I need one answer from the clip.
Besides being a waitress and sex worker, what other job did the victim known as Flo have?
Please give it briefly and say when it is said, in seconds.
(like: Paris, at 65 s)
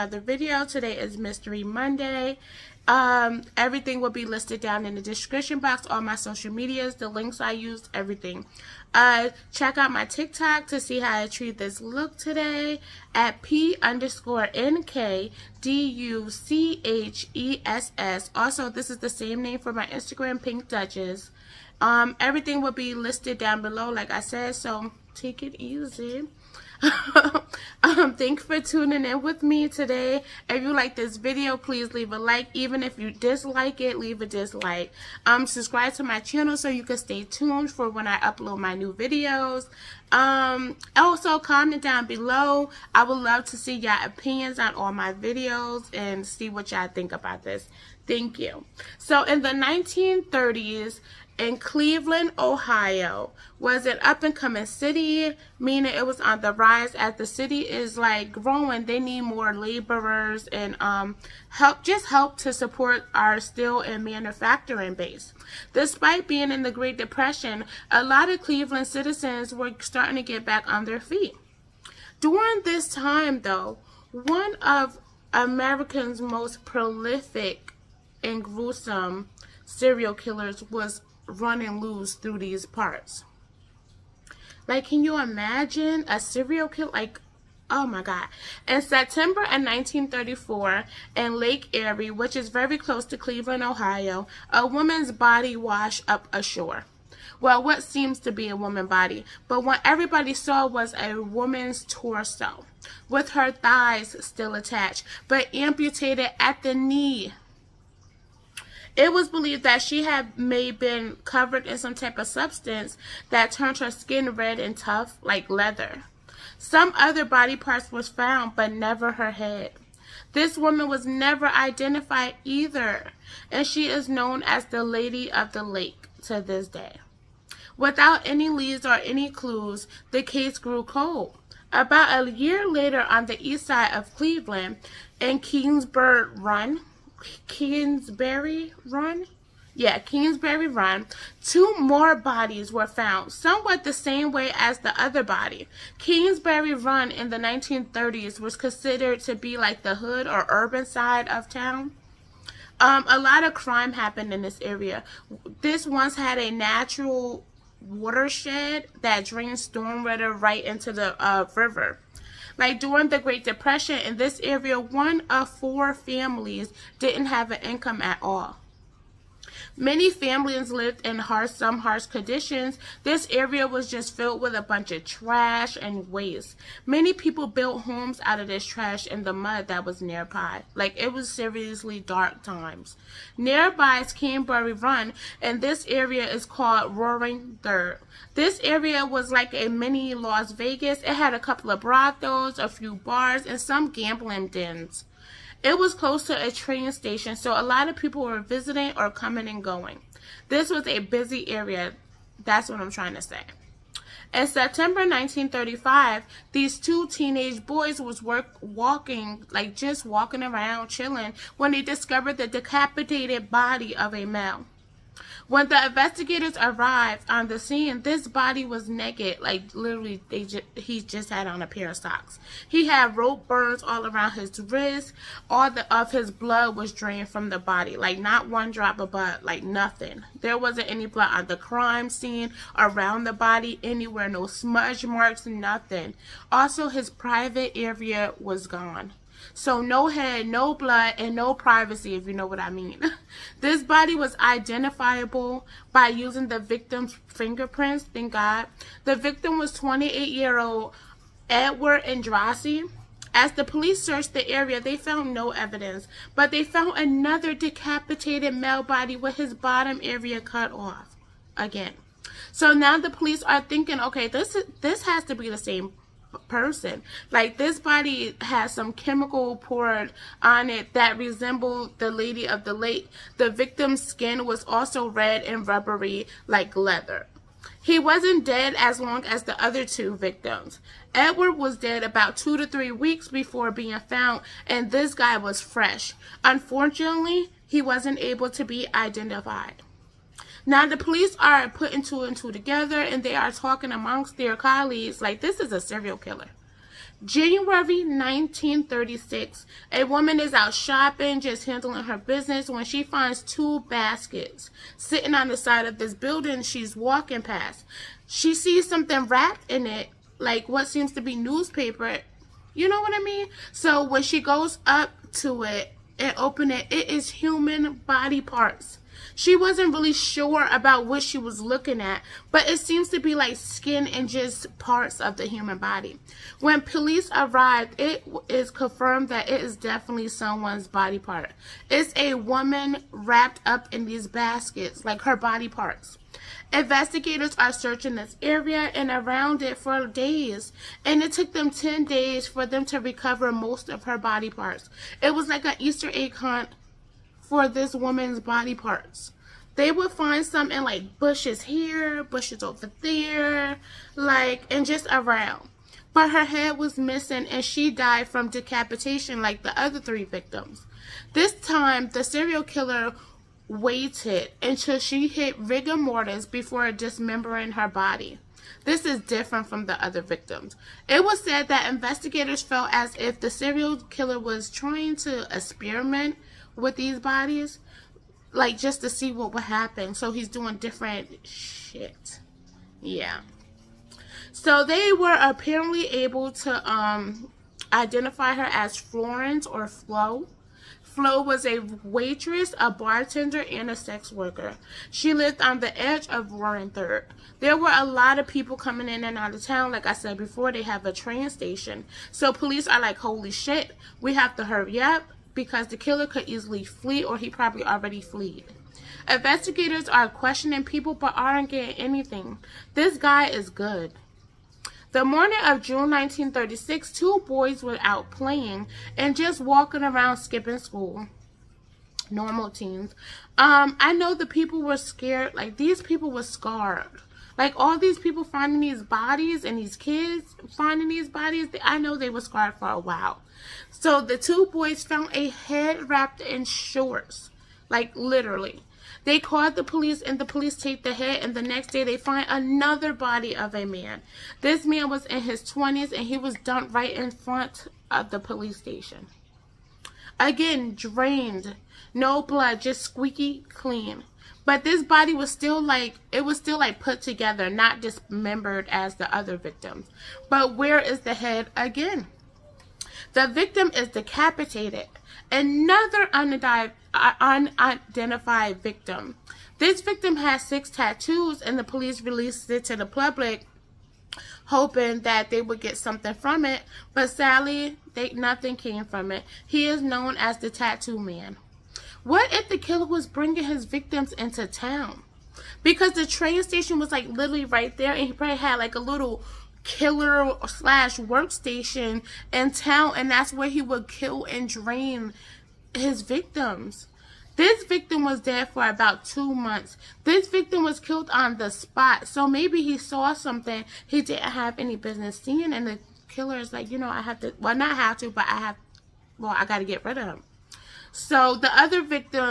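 Bartender, at 392 s.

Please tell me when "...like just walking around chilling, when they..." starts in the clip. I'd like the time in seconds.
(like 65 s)
209 s.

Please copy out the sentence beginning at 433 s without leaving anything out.
So the two boys found a head wrapped in shorts, like literally.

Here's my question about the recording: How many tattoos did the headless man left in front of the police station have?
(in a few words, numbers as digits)
6.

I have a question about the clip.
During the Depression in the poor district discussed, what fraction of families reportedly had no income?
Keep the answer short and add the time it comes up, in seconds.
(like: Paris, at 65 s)
1 in 4, at 164 s.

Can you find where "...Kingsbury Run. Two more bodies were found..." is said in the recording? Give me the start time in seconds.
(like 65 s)
139 s.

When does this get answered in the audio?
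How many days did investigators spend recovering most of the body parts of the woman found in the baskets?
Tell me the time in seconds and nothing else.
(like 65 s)
341 s.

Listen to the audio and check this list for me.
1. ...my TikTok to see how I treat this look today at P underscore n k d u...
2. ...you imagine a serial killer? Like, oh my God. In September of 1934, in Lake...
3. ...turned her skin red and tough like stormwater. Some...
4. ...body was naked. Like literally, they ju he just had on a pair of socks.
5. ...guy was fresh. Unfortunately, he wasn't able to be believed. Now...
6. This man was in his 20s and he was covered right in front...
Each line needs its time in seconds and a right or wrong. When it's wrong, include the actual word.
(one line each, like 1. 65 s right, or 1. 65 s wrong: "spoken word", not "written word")
1. 9 s right
2. 85 s right
3. 113 s wrong: "leather", not "stormwater"
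4. 218 s right
5. 285 s wrong: "identified", not "believed"
6. 444 s wrong: "dumped", not "covered".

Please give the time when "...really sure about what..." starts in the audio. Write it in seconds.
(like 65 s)
319 s.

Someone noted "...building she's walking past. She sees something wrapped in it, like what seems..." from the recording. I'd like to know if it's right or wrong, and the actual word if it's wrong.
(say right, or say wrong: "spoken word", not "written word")
right.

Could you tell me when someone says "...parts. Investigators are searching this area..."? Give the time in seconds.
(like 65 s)
335 s.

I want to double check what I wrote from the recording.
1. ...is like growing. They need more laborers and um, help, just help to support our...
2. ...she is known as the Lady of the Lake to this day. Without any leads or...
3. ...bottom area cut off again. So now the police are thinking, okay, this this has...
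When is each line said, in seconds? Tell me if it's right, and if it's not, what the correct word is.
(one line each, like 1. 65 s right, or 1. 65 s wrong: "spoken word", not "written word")
1. 57 s right
2. 123 s right
3. 259 s right.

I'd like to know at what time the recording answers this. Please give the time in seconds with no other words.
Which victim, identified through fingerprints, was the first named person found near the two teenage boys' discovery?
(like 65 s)
251 s.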